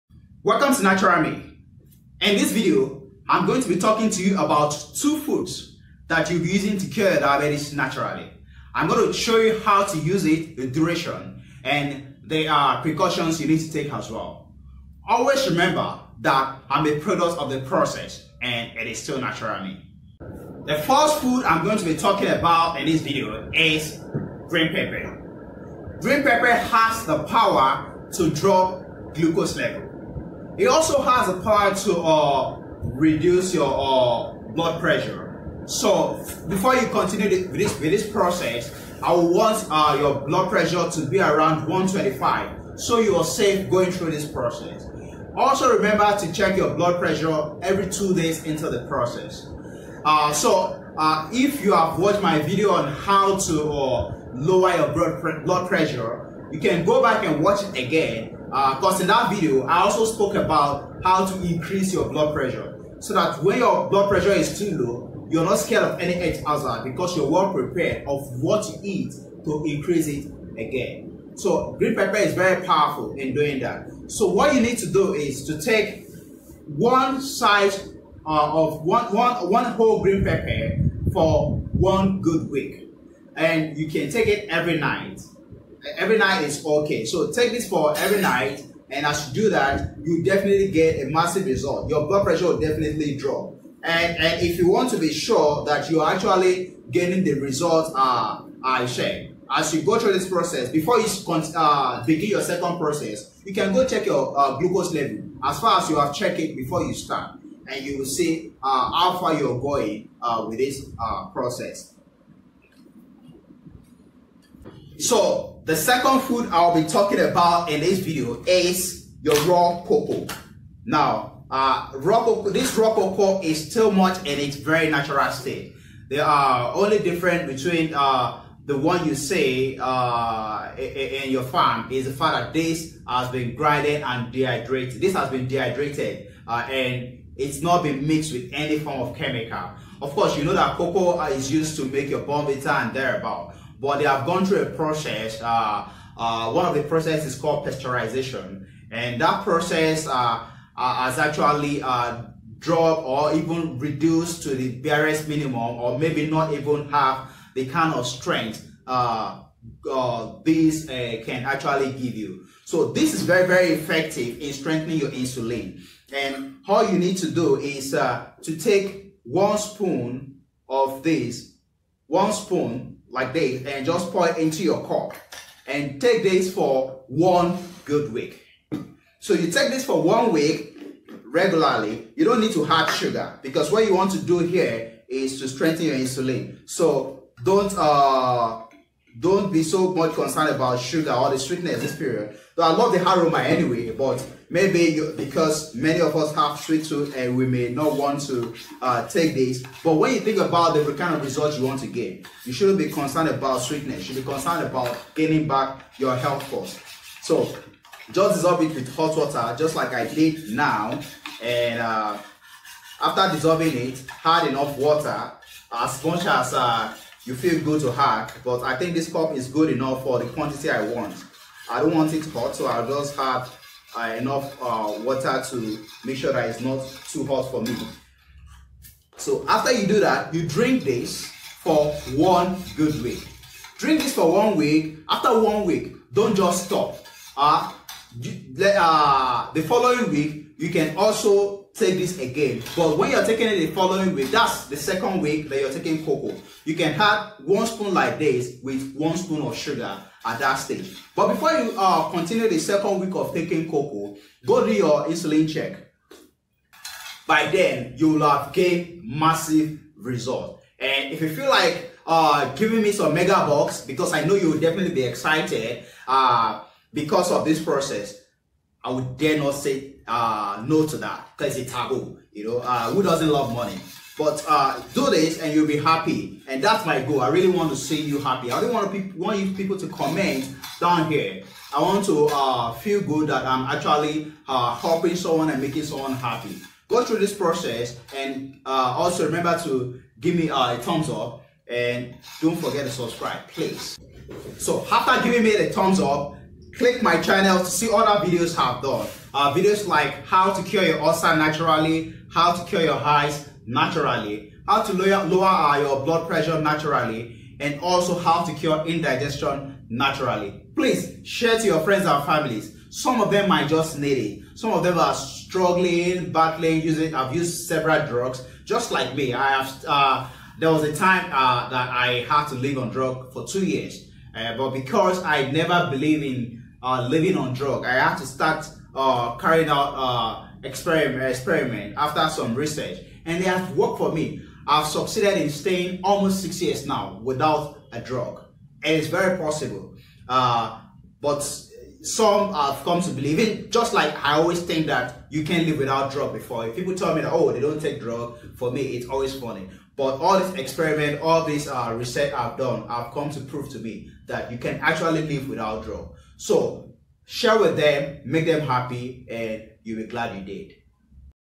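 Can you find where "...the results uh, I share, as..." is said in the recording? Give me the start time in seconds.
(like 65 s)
97 s.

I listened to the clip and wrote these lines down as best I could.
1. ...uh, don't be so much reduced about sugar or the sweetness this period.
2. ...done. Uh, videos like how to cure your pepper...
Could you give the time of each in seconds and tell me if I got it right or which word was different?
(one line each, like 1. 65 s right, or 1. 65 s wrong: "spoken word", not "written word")
1. 187 s wrong: "concerned", not "reduced"
2. 298 s wrong: "ulcer", not "pepper".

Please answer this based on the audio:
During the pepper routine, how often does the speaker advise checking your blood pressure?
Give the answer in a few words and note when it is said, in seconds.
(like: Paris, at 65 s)
every two days, at 47 s.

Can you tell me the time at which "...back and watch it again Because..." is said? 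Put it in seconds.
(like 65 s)
57 s.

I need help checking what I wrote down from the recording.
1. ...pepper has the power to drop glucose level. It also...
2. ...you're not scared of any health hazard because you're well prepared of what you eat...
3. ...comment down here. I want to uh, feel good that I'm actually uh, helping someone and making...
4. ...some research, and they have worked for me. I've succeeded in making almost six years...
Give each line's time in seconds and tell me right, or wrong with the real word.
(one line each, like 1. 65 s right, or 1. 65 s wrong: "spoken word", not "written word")
1. 26 s right
2. 65 s right
3. 279 s right
4. 332 s wrong: "staying", not "making".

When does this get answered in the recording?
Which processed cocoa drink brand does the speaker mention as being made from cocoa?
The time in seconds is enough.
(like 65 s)
142 s.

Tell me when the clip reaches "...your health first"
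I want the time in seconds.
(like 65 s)
205 s.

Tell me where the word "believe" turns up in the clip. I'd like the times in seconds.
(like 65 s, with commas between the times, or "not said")
325 s, 343 s.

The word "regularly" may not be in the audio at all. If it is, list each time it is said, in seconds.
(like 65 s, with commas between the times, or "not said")
181 s.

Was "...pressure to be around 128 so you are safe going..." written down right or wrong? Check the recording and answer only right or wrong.
wrong.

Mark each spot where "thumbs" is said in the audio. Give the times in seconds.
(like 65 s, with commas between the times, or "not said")
290 s, 295 s.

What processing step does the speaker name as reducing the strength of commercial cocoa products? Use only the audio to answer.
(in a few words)
pasteurization.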